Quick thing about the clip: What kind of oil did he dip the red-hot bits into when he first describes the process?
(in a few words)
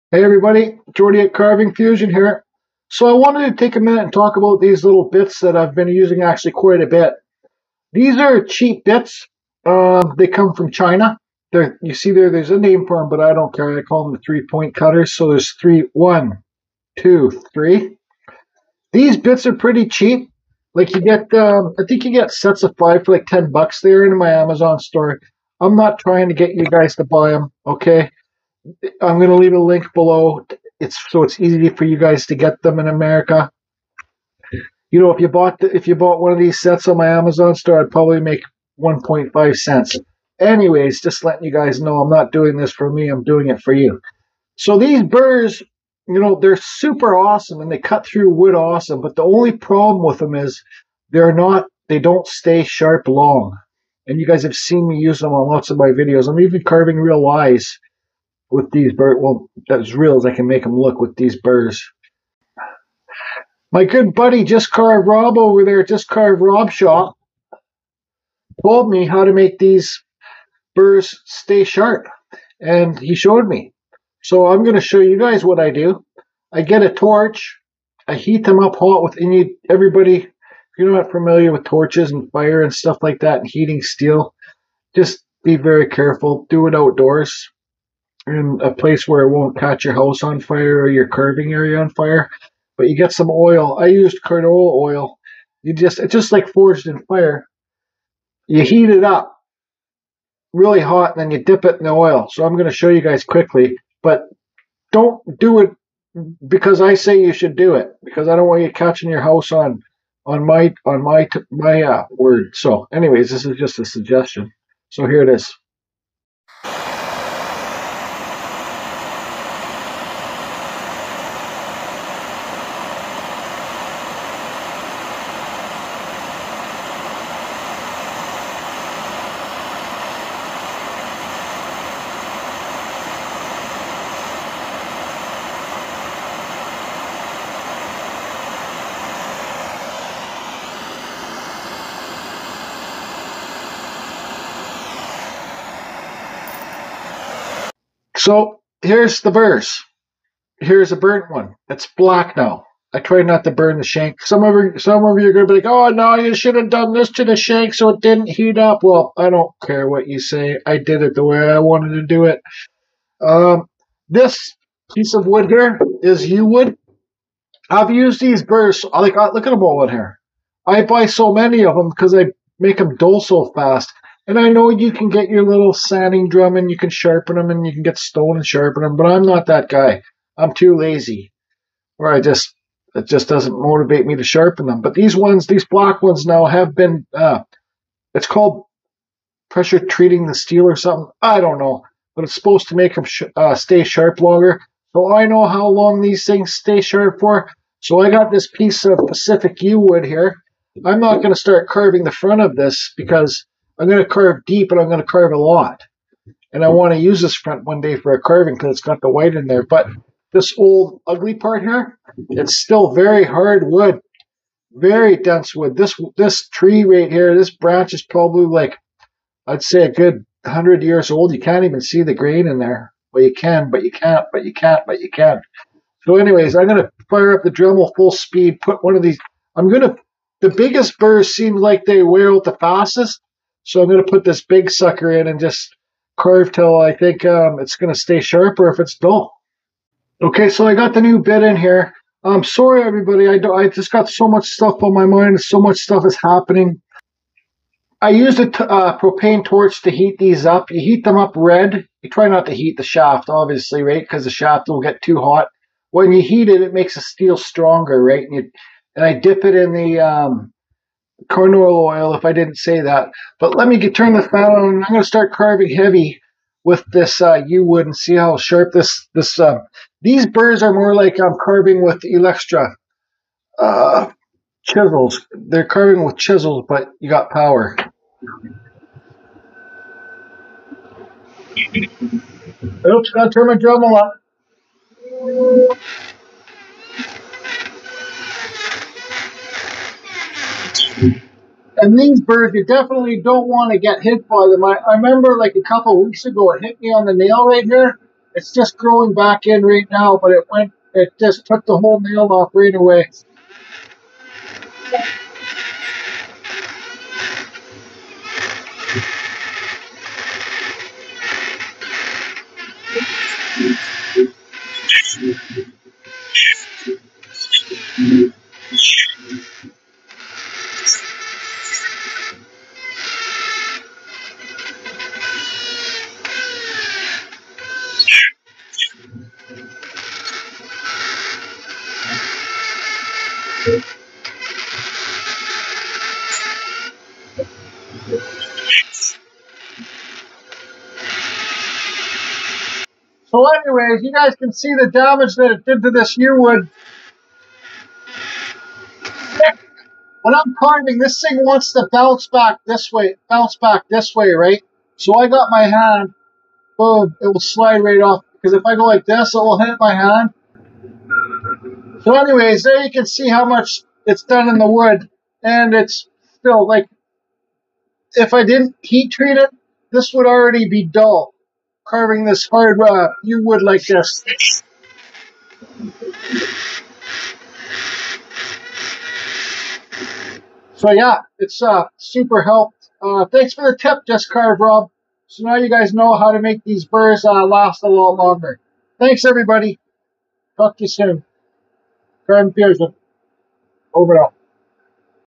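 canola oil.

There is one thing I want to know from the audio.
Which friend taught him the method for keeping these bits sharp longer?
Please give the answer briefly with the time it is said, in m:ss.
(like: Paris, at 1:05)
Rob Shaw, at 1:06.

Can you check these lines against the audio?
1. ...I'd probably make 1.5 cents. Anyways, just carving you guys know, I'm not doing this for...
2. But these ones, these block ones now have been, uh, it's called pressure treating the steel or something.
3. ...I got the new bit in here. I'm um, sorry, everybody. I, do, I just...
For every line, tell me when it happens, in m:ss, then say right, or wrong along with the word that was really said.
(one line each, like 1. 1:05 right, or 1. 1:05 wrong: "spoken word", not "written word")
1. 0:37 wrong: "letting", not "carving"
2. 3:04 right
3. 4:00 right.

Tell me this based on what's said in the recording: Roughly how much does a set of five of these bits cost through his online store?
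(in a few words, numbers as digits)
10 bucks.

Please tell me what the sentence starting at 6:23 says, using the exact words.
Uh, thanks for the tip, Just Carve Rob.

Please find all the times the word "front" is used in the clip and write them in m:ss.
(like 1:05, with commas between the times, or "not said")
3:22, 3:27.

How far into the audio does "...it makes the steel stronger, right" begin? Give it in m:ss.
4:16.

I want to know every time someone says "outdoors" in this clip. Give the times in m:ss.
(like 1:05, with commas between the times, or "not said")
1:26.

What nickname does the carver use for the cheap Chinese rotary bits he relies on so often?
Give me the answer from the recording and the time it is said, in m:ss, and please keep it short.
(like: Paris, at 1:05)
three-point cutters, at 0:14.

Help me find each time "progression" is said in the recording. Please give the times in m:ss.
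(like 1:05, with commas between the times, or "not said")
not said.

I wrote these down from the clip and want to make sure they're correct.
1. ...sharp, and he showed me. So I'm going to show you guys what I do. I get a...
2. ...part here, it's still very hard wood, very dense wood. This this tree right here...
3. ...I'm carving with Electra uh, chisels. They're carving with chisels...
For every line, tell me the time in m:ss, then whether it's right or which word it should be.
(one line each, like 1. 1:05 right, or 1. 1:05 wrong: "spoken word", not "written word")
1. 1:11 right
2. 3:31 right
3. 4:31 right.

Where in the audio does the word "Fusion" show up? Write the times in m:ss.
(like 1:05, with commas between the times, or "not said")
0:01, 6:32.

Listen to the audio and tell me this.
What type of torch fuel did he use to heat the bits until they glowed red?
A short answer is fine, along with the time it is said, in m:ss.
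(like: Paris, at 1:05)
propane, at 4:08.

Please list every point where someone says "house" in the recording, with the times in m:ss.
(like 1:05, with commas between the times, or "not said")
1:29, 1:49.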